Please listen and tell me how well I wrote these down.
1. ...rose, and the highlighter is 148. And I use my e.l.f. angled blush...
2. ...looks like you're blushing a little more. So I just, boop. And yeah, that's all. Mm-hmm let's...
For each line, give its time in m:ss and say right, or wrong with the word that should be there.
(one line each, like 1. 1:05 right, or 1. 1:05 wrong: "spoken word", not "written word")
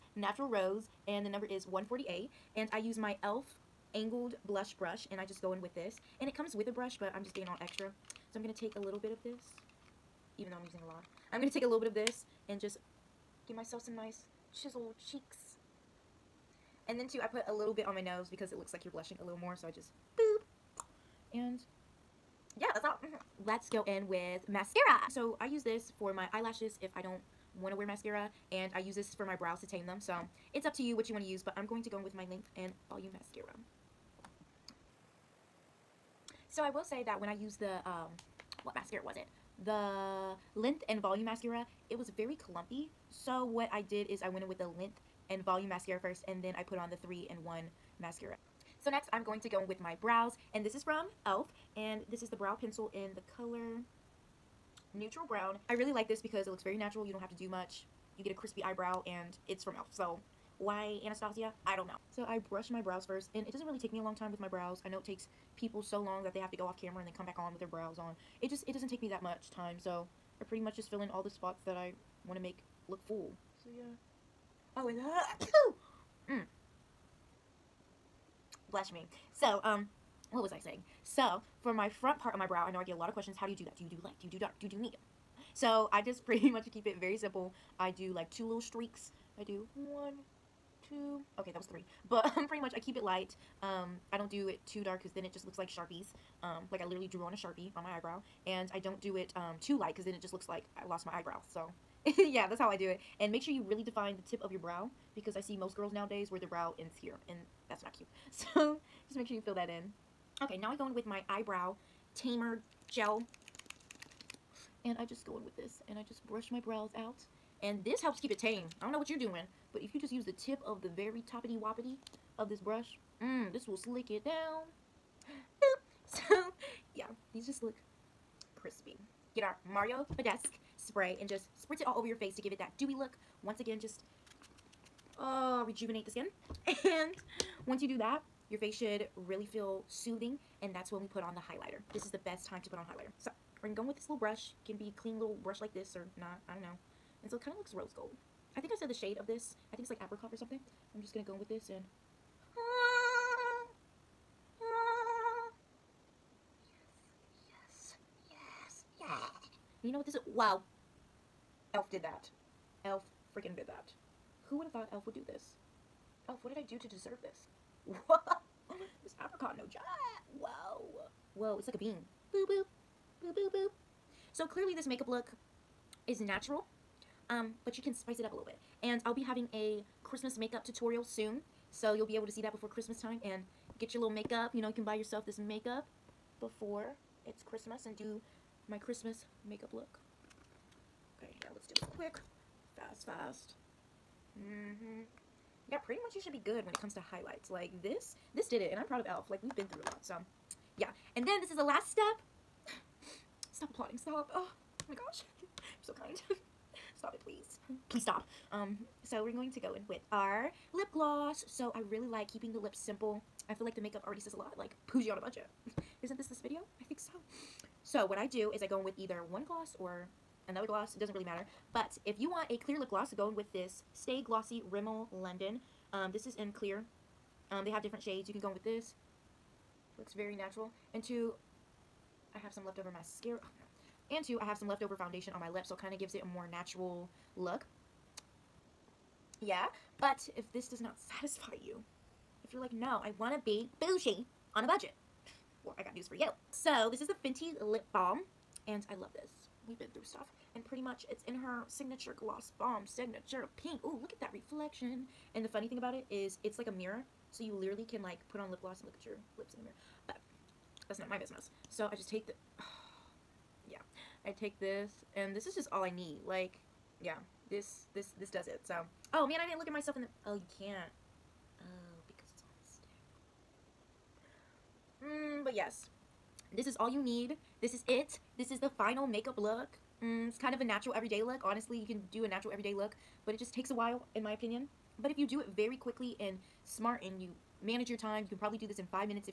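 1. 0:00 wrong: "number", not "highlighter"
2. 0:18 right.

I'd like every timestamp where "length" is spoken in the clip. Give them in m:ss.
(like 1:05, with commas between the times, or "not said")
0:32, 0:40, 0:44.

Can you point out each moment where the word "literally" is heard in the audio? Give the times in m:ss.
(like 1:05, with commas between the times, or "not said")
1:36, 4:17.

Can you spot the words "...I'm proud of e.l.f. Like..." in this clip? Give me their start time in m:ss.
3:18.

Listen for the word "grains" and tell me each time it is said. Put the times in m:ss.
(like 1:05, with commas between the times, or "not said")
not said.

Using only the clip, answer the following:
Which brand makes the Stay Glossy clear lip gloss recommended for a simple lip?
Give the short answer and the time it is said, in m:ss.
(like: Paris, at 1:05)
Rimmel London, at 3:44.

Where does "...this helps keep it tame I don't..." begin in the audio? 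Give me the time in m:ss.
1:57.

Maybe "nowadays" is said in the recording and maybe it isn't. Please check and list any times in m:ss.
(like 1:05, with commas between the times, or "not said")
1:45.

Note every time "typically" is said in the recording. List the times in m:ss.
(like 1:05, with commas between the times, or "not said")
not said.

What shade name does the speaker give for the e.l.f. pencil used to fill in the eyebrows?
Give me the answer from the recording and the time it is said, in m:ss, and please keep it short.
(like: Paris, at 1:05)
neutral brown, at 0:54.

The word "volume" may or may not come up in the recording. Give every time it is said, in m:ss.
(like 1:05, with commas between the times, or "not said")
0:32, 0:41, 0:45.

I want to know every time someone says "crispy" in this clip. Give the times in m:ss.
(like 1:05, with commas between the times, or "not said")
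0:58, 2:08.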